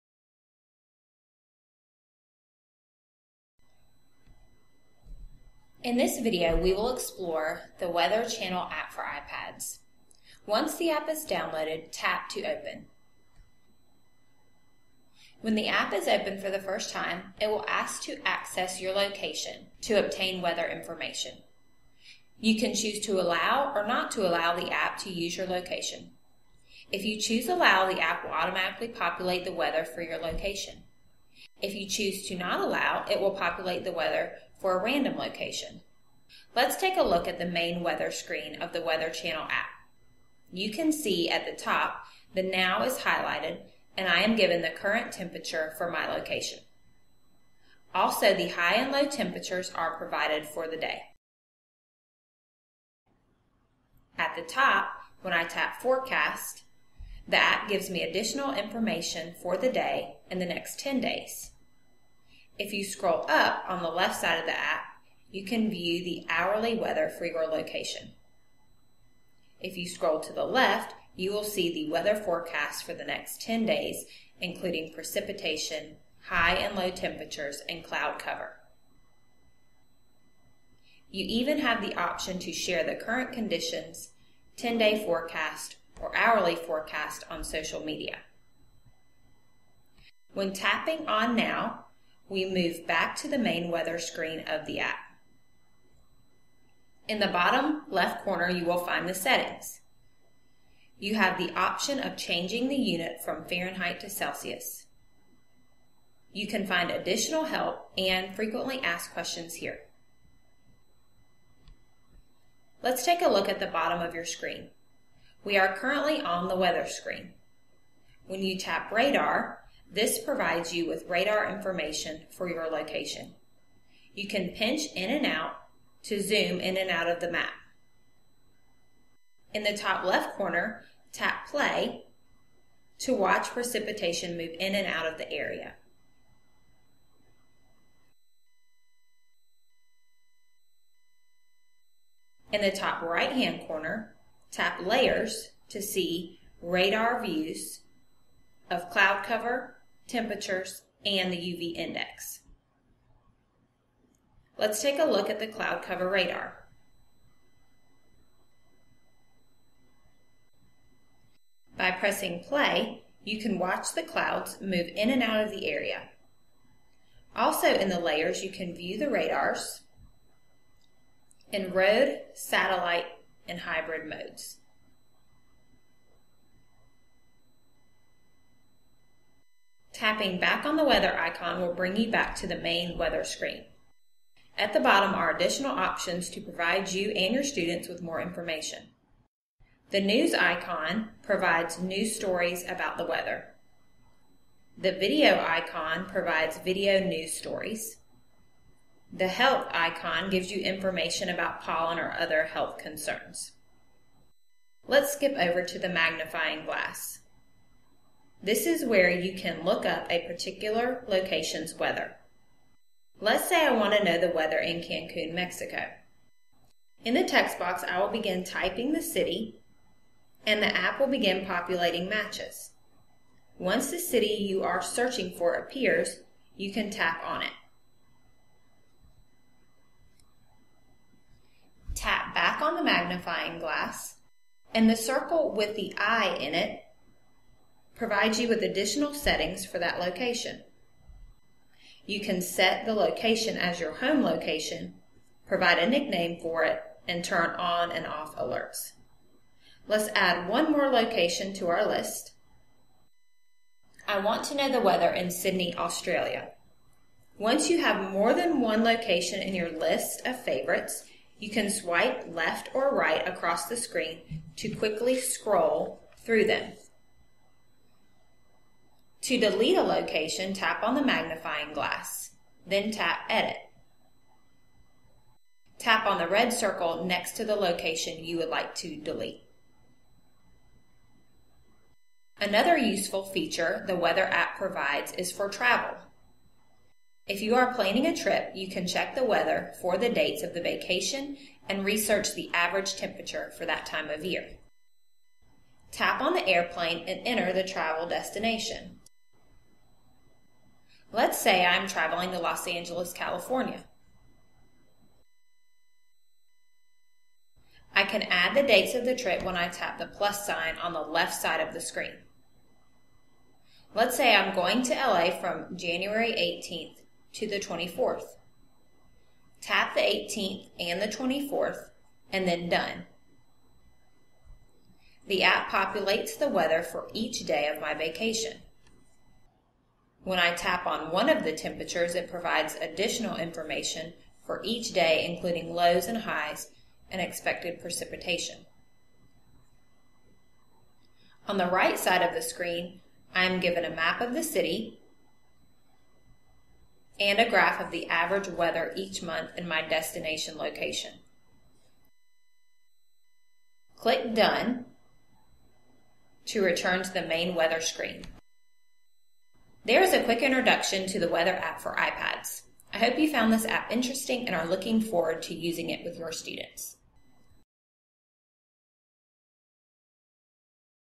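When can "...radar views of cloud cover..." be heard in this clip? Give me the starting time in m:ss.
2:26.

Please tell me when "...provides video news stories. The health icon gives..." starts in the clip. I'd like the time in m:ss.
3:16.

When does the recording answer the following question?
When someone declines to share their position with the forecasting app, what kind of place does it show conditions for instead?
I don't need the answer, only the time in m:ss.
0:34.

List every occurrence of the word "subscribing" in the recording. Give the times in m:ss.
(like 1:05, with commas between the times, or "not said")
not said.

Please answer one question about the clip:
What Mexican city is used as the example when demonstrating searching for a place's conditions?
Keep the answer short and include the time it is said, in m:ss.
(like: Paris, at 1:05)
Cancun, at 3:34.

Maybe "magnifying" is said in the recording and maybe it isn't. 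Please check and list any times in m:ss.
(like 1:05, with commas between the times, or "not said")
3:25, 3:52, 4:31.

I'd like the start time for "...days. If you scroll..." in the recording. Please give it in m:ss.
1:01.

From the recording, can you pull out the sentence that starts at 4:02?
You can set the location as your home location, provide a nickname for it, and turn on and off alerts.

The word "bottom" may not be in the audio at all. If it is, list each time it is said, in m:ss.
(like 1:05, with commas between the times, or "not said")
1:37, 1:53, 3:04.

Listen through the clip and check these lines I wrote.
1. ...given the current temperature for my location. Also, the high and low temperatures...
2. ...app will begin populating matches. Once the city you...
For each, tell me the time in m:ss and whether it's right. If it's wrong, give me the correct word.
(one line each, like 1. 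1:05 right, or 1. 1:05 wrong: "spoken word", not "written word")
1. 0:44 right
2. 3:40 right.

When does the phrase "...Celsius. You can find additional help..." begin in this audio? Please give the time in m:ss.
1:44.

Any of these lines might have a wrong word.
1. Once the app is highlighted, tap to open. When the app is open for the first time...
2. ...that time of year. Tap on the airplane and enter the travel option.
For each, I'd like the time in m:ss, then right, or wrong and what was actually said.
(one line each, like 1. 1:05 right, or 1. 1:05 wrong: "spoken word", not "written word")
1. 0:10 wrong: "downloaded", not "highlighted"
2. 4:53 wrong: "destination", not "option".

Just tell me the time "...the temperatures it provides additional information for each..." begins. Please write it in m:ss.
5:31.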